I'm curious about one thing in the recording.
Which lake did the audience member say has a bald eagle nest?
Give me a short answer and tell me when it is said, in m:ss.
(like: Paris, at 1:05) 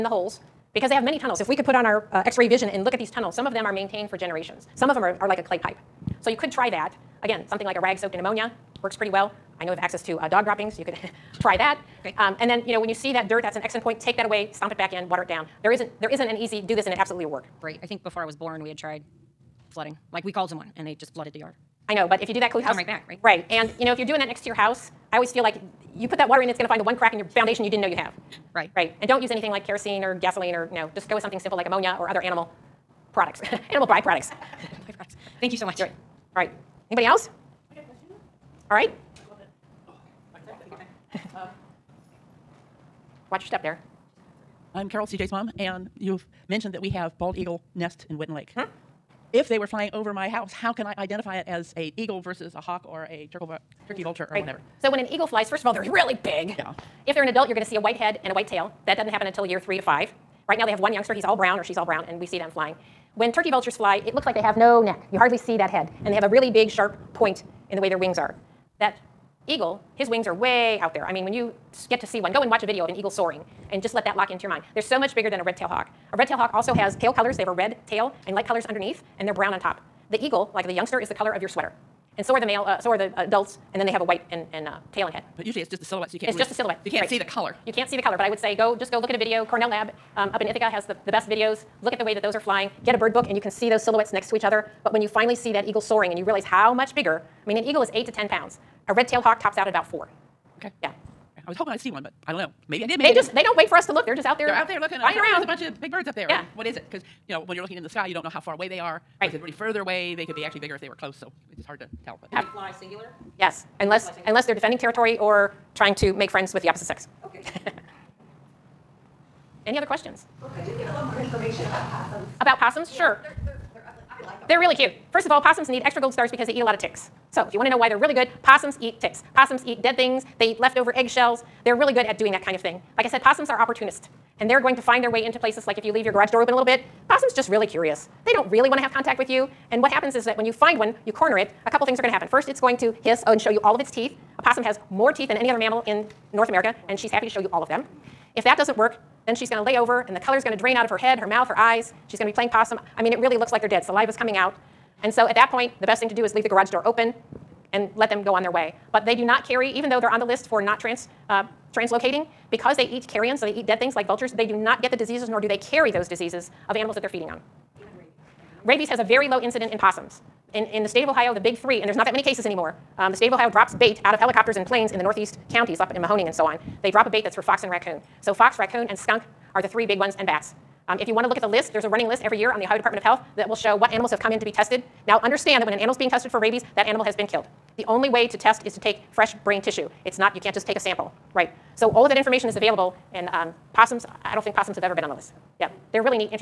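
Winton Lake, at 0:48.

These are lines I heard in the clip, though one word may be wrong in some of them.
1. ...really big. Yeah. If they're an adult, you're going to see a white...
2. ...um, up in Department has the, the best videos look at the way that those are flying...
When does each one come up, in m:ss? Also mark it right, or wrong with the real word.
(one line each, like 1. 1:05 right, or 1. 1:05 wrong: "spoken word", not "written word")
1. 0:55 right
2. 1:30 wrong: "Ithaca", not "Department".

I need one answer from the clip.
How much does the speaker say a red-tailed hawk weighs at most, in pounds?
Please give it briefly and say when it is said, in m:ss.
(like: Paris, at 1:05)
4, at 1:39.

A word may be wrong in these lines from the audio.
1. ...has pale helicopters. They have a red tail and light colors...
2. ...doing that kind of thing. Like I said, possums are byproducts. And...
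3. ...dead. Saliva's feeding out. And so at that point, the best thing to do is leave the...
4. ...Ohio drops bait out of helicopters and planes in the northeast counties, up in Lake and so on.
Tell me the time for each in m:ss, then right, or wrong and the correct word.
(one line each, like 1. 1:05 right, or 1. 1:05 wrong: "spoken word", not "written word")
1. 1:16 wrong: "colors", not "helicopters"
2. 2:12 wrong: "opportunists", not "byproducts"
3. 2:33 wrong: "coming", not "feeding"
4. 2:53 wrong: "Mahoning", not "Lake".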